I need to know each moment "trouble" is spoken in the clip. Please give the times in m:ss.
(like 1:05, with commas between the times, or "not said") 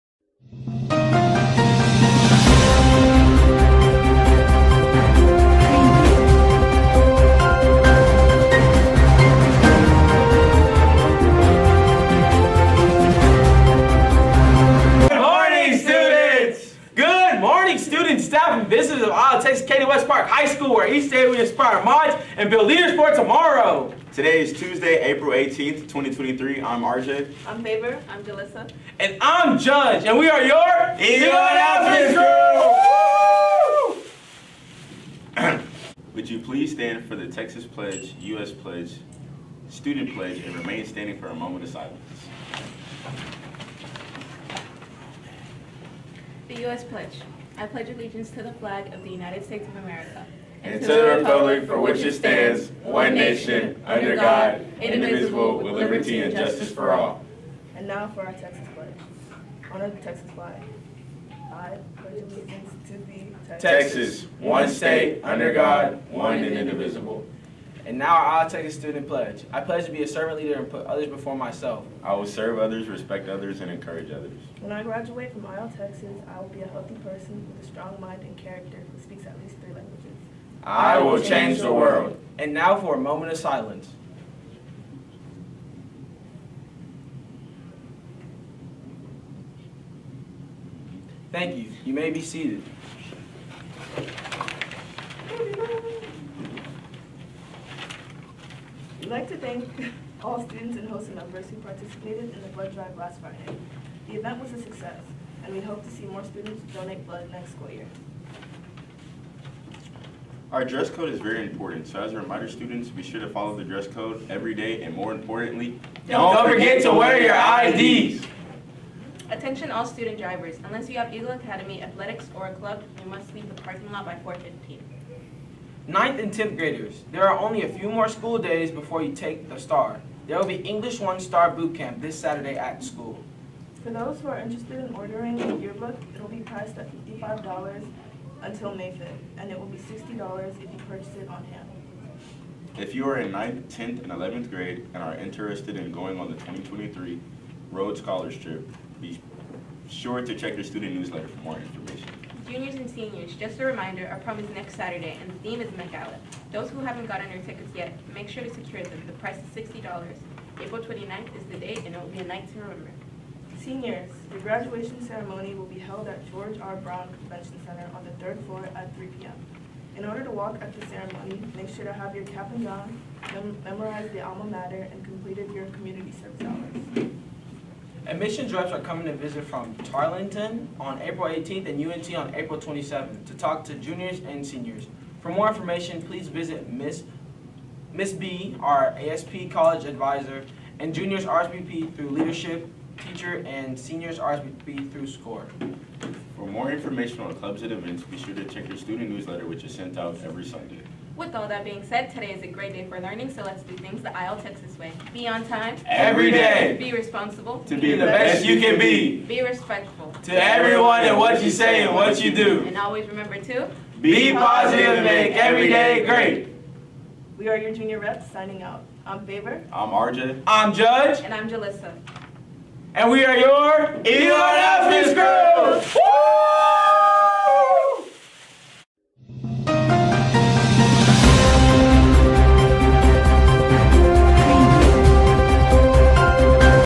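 not said.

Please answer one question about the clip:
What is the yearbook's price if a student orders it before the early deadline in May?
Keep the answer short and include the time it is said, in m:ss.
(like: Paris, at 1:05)
$55, at 2:17.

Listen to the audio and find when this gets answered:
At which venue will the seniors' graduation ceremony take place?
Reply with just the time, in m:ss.
2:46.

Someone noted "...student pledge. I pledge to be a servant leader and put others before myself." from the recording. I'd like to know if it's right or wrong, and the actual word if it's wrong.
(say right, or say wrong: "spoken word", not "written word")
right.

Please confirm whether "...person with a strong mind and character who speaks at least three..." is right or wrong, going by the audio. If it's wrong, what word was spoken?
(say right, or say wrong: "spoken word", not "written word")
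right.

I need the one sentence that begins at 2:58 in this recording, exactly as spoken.
Admissions reps are coming to visit from Tarleton on April 18th and UNT on April 27th to talk to juniors and seniors.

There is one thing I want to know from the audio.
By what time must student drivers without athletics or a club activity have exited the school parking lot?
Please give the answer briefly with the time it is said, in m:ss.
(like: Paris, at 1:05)
4:15, at 2:04.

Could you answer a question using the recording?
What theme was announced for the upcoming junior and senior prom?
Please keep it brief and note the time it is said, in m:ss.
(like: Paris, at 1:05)
Met Gala, at 2:35.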